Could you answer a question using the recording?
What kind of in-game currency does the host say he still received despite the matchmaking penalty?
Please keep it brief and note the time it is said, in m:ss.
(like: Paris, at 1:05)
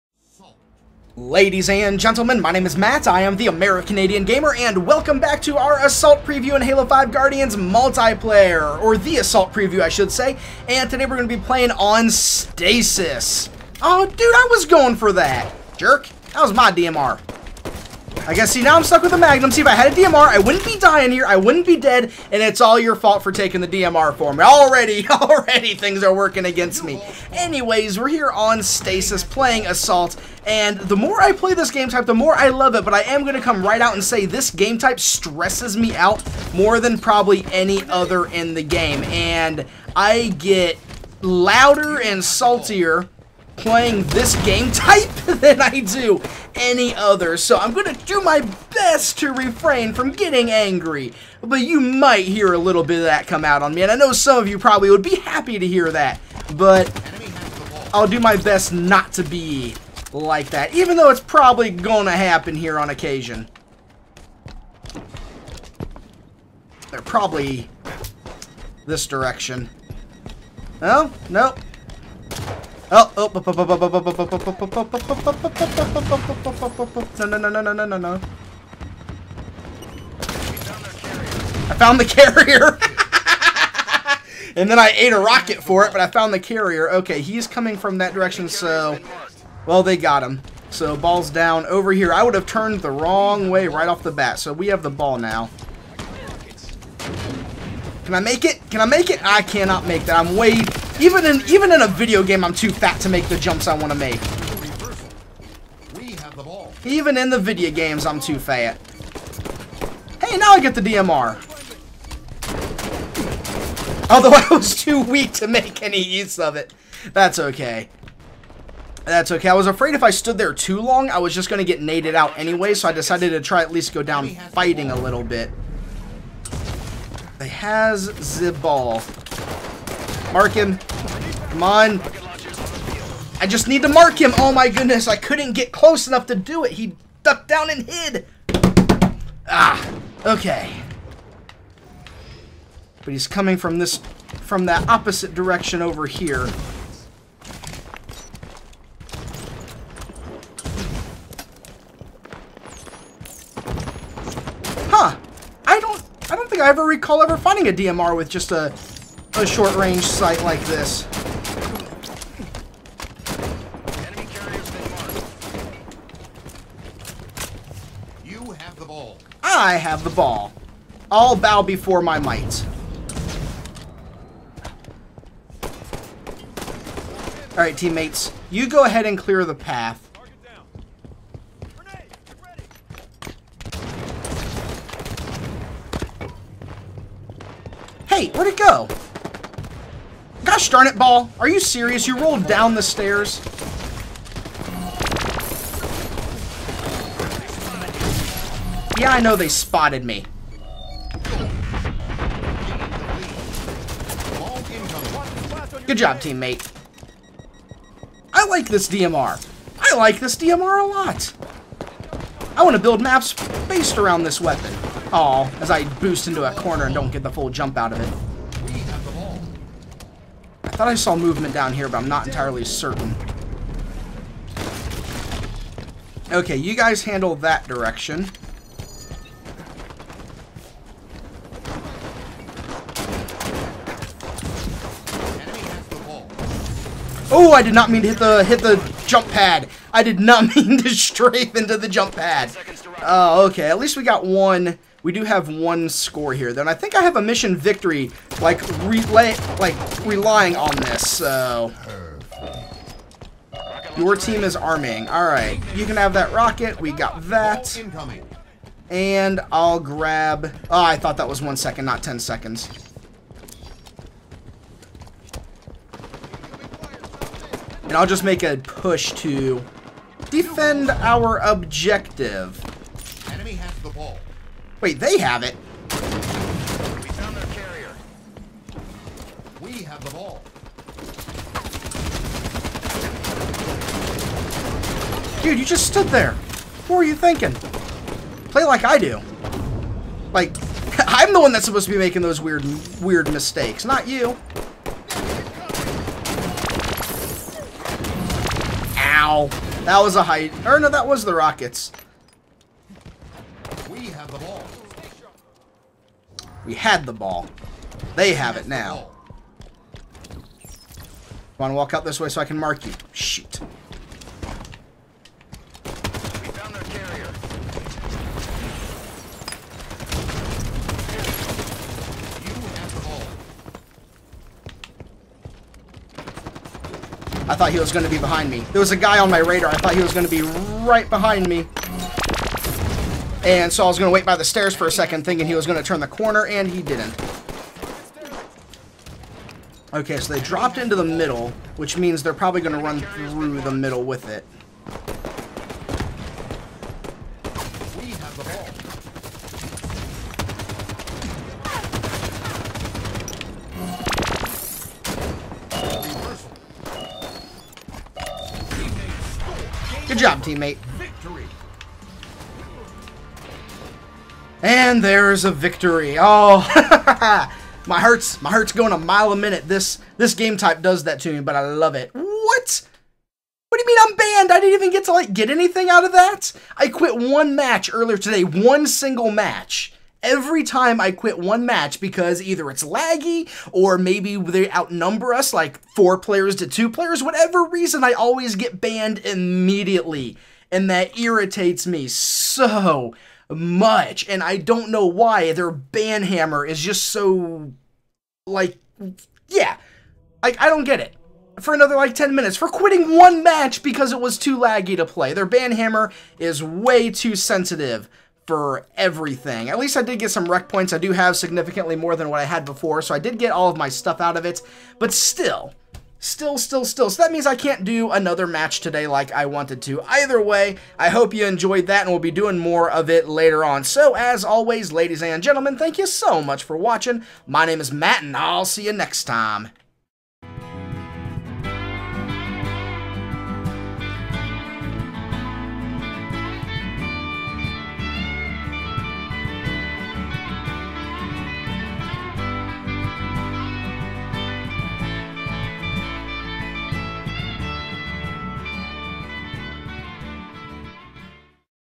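REQ points, at 6:50.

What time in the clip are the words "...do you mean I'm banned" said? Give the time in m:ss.
6:13.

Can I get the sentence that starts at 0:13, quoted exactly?
Oh dude, I was going for that.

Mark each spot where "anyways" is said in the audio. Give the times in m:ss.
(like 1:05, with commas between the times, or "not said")
0:27, 2:02.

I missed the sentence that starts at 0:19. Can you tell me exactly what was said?
See, if I had a DMR, I wouldn't be dying here.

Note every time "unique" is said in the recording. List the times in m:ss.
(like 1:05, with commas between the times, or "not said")
not said.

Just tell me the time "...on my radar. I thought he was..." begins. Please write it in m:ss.
5:29.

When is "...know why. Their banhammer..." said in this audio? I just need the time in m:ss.
6:34.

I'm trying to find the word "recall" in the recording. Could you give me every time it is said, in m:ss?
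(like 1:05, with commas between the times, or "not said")
2:36.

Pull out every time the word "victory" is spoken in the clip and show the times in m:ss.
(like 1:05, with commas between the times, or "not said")
4:07, 6:05.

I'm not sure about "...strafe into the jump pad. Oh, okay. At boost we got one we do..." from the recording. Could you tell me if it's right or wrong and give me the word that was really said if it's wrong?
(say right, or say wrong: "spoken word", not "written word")
wrong: "least", not "boost".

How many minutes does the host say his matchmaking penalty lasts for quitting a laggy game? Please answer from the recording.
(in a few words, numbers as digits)
10.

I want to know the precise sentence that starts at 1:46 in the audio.
Even in the video games, I'm too fat.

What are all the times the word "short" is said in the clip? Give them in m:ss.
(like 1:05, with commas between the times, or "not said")
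2:39.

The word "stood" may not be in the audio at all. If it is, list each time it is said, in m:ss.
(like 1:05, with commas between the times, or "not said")
2:00, 4:45.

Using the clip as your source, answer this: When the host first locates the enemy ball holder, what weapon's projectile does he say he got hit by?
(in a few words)
a rocket.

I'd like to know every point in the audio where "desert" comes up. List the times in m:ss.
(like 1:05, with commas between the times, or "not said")
not said.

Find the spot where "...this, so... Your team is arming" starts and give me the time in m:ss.
4:10.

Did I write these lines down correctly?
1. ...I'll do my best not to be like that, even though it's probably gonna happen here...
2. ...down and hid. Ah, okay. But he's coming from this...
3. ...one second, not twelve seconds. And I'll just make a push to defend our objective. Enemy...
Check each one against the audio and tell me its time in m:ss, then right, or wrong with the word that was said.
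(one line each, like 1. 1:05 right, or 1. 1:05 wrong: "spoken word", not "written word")
1. 0:57 right
2. 2:17 right
3. 4:21 wrong: "ten", not "twelve".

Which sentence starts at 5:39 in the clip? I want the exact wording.
Okay, so they dropped into the middle, which means they're probably going to run through the middle with it.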